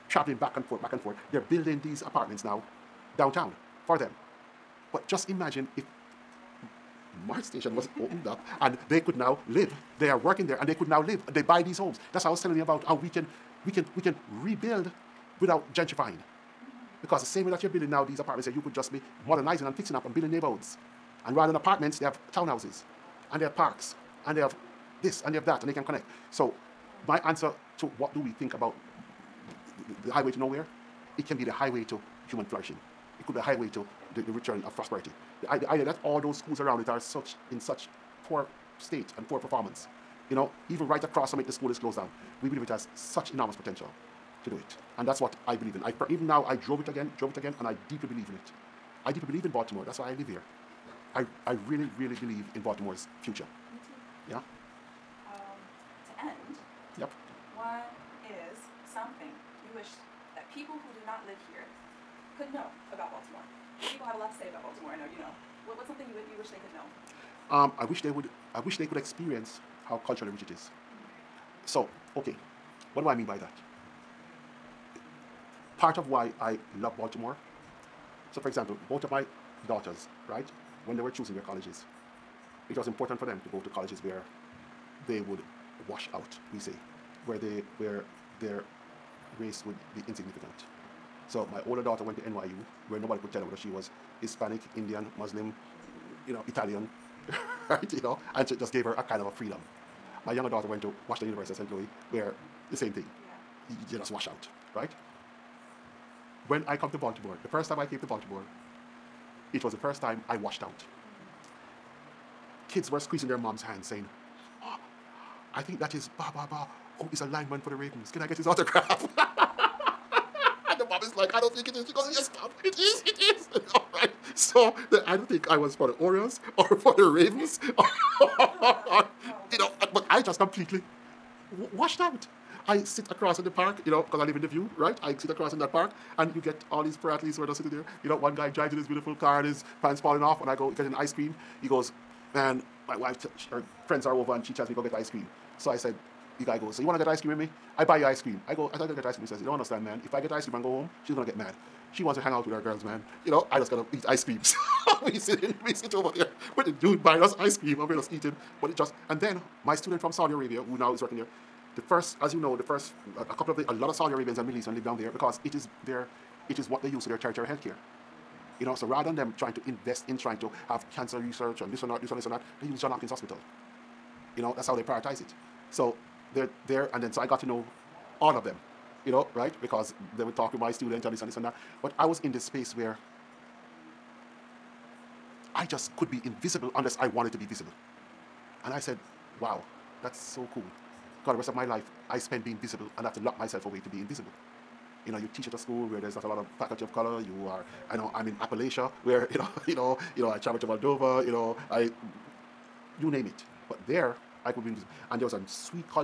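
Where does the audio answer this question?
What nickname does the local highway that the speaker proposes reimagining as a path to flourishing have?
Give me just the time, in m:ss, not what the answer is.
0:30.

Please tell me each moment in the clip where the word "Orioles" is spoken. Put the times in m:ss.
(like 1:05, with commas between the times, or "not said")
2:05.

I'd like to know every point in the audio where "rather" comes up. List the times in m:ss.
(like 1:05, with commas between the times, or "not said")
0:21, 2:48.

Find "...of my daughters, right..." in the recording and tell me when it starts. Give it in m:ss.
1:19.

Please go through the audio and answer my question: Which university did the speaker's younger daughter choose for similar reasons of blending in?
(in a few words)
Washington University, St. Louis.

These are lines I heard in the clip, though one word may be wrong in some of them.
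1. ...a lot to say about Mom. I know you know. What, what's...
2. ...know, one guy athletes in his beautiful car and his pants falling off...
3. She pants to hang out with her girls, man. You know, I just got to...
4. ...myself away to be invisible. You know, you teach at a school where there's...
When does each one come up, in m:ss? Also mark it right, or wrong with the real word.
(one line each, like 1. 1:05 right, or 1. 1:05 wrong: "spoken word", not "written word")
1. 1:04 wrong: "Baltimore", not "Mom"
2. 2:18 wrong: "drives", not "athletes"
3. 2:31 wrong: "wants", not "pants"
4. 3:13 right.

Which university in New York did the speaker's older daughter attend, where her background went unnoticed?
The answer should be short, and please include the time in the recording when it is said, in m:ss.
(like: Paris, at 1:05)
NYU, at 1:32.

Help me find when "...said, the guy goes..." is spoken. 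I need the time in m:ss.
2:25.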